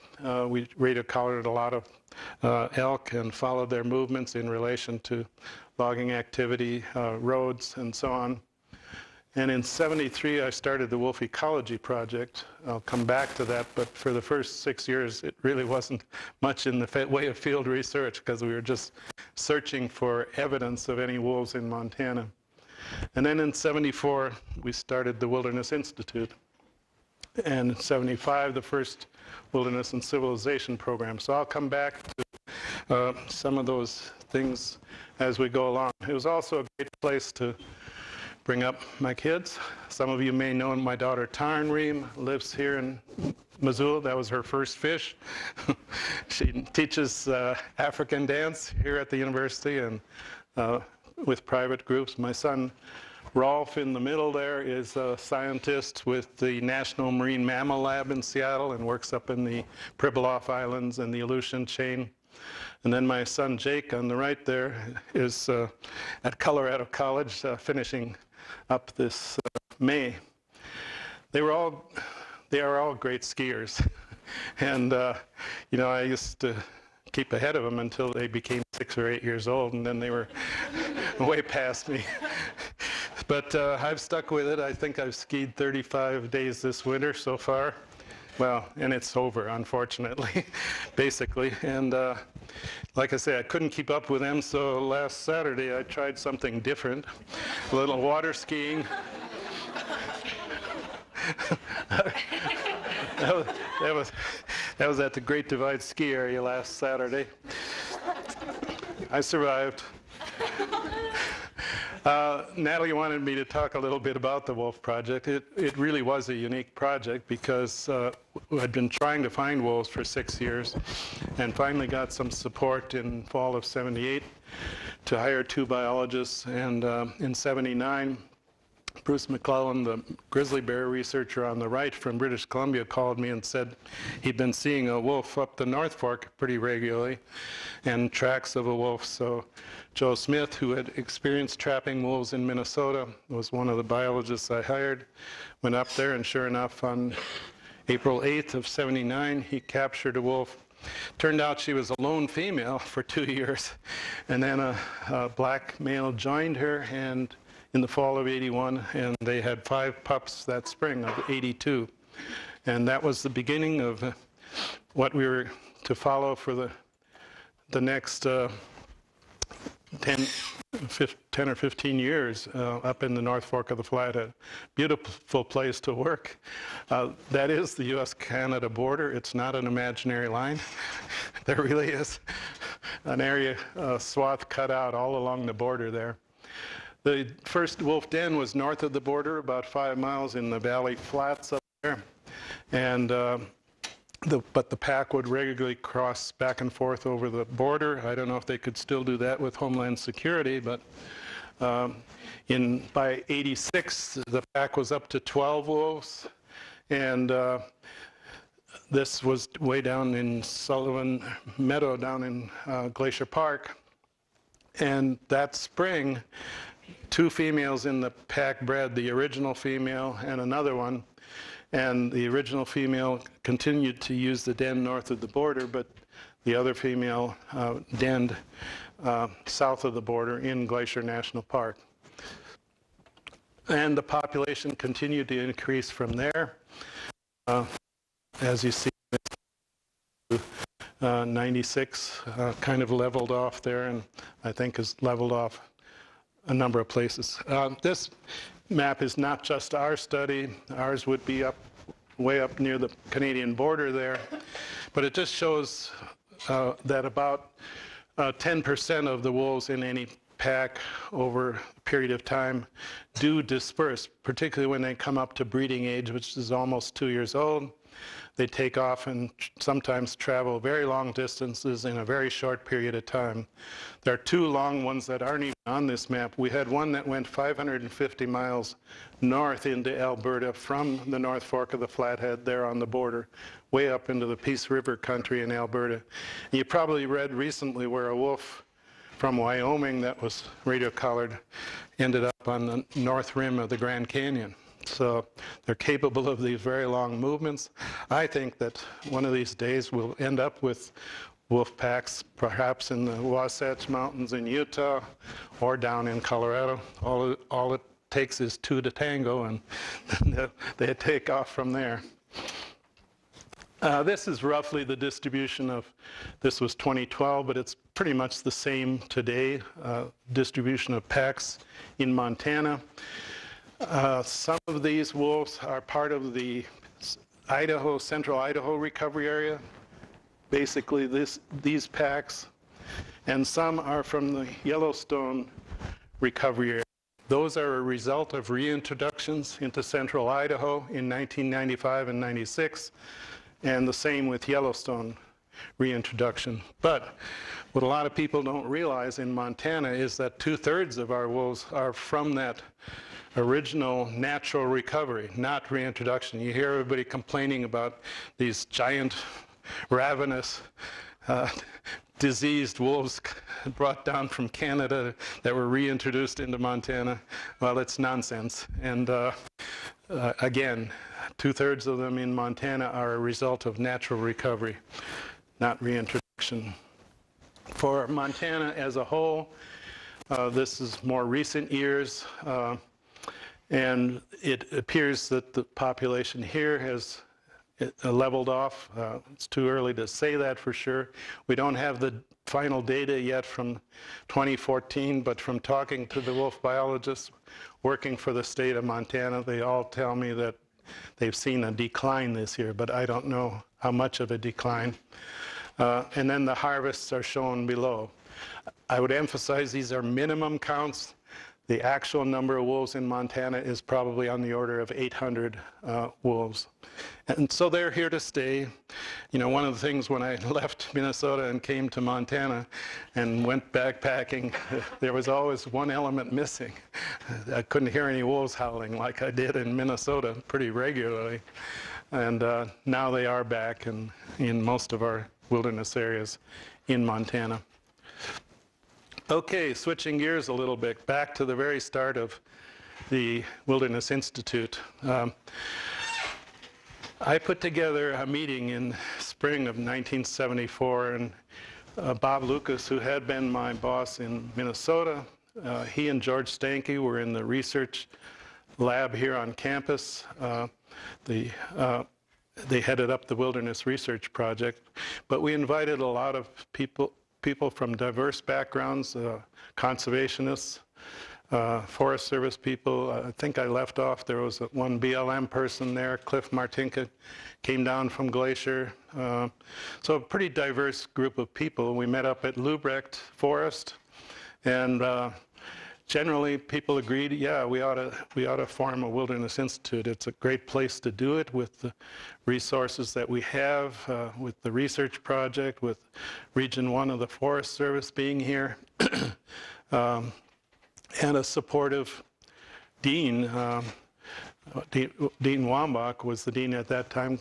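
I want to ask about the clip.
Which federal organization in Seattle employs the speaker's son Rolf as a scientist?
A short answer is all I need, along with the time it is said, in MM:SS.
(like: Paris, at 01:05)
National Marine Mammal Lab, at 00:56.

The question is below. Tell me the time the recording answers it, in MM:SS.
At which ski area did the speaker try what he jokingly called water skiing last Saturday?
01:45.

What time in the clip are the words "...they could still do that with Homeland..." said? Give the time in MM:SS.
03:18.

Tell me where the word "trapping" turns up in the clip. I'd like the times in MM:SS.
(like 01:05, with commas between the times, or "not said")
02:21.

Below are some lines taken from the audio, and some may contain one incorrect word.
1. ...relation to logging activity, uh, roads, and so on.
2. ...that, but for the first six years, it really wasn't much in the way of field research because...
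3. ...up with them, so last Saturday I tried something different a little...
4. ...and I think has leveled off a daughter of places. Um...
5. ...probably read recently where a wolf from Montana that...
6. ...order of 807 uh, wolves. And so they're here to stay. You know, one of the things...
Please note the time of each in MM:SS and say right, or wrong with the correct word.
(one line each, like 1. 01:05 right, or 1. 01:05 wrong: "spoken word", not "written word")
1. 00:04 right
2. 00:13 right
3. 01:33 right
4. 04:03 wrong: "number", not "daughter"
5. 04:46 wrong: "Wyoming", not "Montana"
6. 06:54 wrong: "800", not "807".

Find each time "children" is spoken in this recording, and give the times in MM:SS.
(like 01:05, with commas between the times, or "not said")
not said.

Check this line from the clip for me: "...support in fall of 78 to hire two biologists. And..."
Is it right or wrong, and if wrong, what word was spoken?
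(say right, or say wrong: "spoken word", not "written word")
right.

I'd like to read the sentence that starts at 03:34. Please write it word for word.
And that spring, two females in the pack bred, the original female and another one.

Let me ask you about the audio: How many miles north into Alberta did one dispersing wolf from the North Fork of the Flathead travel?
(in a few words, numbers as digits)
550.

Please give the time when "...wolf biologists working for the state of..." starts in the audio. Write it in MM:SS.
06:36.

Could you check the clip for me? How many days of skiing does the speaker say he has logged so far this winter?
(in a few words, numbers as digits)
35.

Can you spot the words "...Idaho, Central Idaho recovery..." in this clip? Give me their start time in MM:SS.
05:27.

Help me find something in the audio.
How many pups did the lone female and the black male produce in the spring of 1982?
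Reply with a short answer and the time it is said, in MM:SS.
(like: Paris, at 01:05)
5, at 02:39.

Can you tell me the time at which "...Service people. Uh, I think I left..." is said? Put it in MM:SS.
07:52.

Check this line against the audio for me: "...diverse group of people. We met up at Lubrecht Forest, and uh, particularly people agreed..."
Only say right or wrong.
wrong.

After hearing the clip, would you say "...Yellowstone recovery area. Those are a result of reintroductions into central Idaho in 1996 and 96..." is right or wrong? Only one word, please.
wrong.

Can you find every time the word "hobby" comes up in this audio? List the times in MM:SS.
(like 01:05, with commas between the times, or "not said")
not said.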